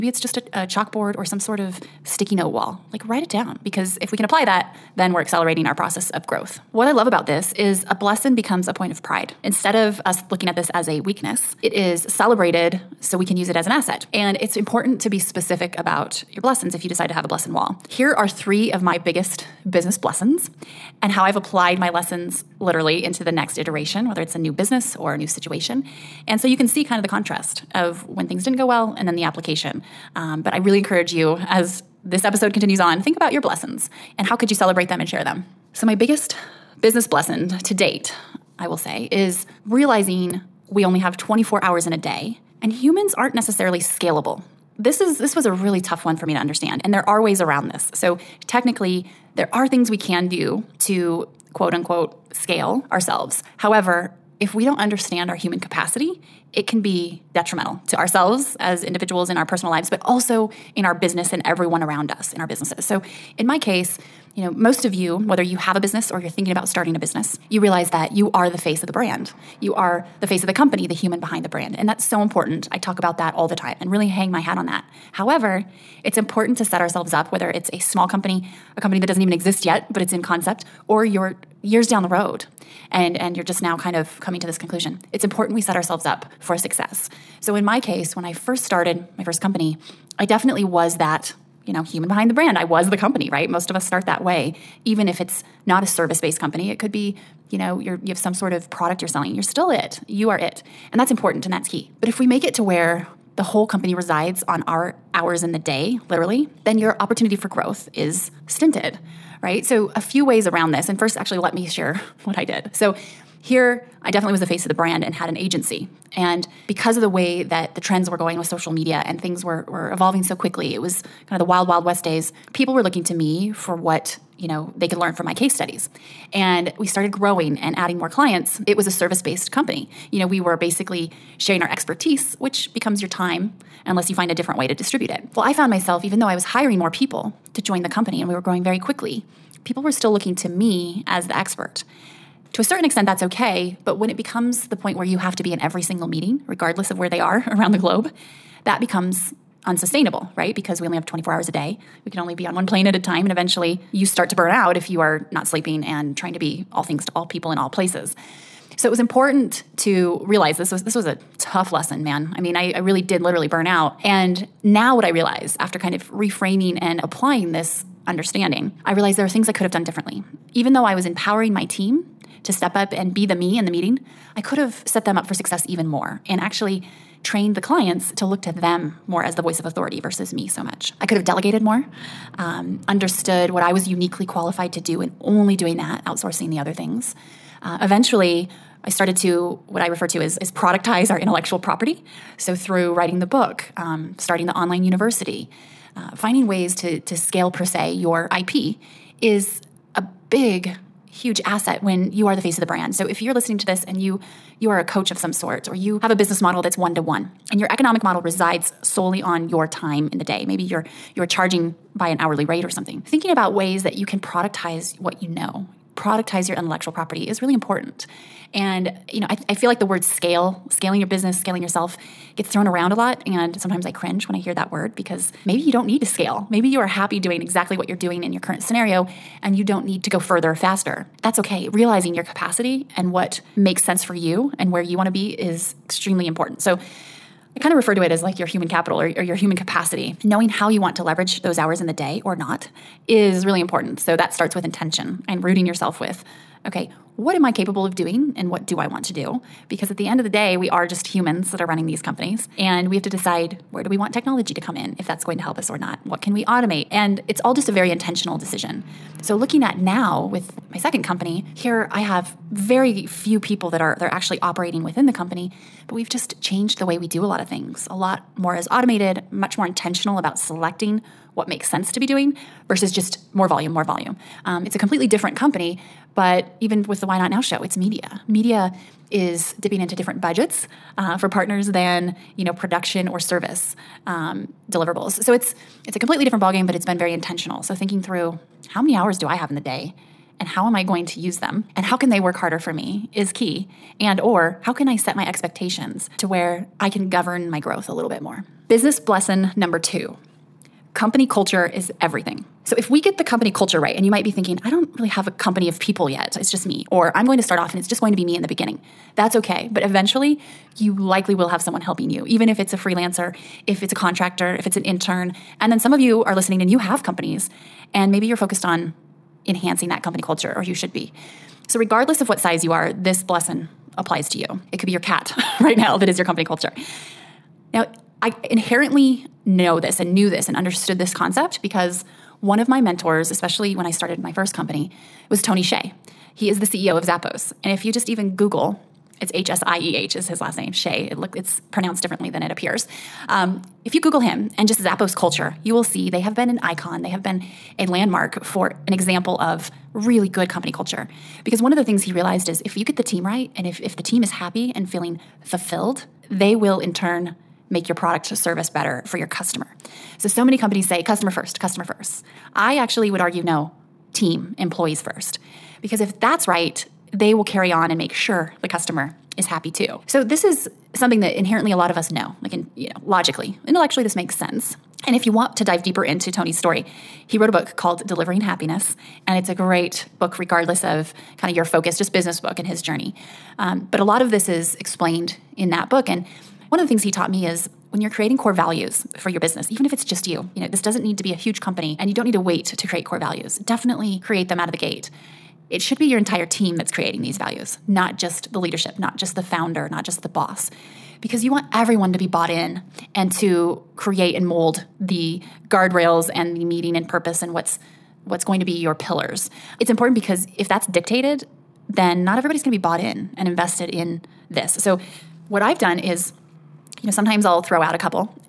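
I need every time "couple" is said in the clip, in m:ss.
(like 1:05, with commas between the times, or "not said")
6:57.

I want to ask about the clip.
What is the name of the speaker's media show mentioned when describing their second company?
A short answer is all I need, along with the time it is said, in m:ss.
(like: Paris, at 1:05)
Why Not Now, at 4:37.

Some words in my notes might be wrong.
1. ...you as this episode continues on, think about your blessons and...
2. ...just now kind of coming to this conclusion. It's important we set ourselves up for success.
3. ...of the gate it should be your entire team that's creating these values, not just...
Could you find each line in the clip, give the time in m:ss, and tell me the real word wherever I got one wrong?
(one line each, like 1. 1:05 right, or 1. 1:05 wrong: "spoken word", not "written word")
1. 0:31 right
2. 1:23 right
3. 6:34 right.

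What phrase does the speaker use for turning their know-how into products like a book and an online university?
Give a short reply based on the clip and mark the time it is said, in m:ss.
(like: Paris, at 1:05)
productize our intellectual property, at 3:10.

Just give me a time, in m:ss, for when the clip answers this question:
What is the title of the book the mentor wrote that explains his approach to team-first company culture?
6:18.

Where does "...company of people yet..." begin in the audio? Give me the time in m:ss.
5:05.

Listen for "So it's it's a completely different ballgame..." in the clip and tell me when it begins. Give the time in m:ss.
4:45.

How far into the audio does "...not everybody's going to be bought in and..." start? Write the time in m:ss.
6:52.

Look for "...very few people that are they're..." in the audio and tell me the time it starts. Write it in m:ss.
4:22.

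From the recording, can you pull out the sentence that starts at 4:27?
A lot more is automated, much more intentional about selecting what makes sense to be doing versus just more volume, more volume.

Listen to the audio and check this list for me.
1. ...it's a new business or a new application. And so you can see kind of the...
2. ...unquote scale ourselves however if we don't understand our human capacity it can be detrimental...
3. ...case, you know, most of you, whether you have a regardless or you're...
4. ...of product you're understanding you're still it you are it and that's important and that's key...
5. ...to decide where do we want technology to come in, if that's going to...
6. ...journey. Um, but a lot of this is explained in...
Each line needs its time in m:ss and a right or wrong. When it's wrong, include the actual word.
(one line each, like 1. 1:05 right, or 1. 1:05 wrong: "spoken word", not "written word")
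1. 0:24 wrong: "situation", not "application"
2. 0:51 right
3. 1:03 wrong: "business", not "regardless"
4. 1:38 wrong: "selling", not "understanding"
5. 4:13 right
6. 6:22 right.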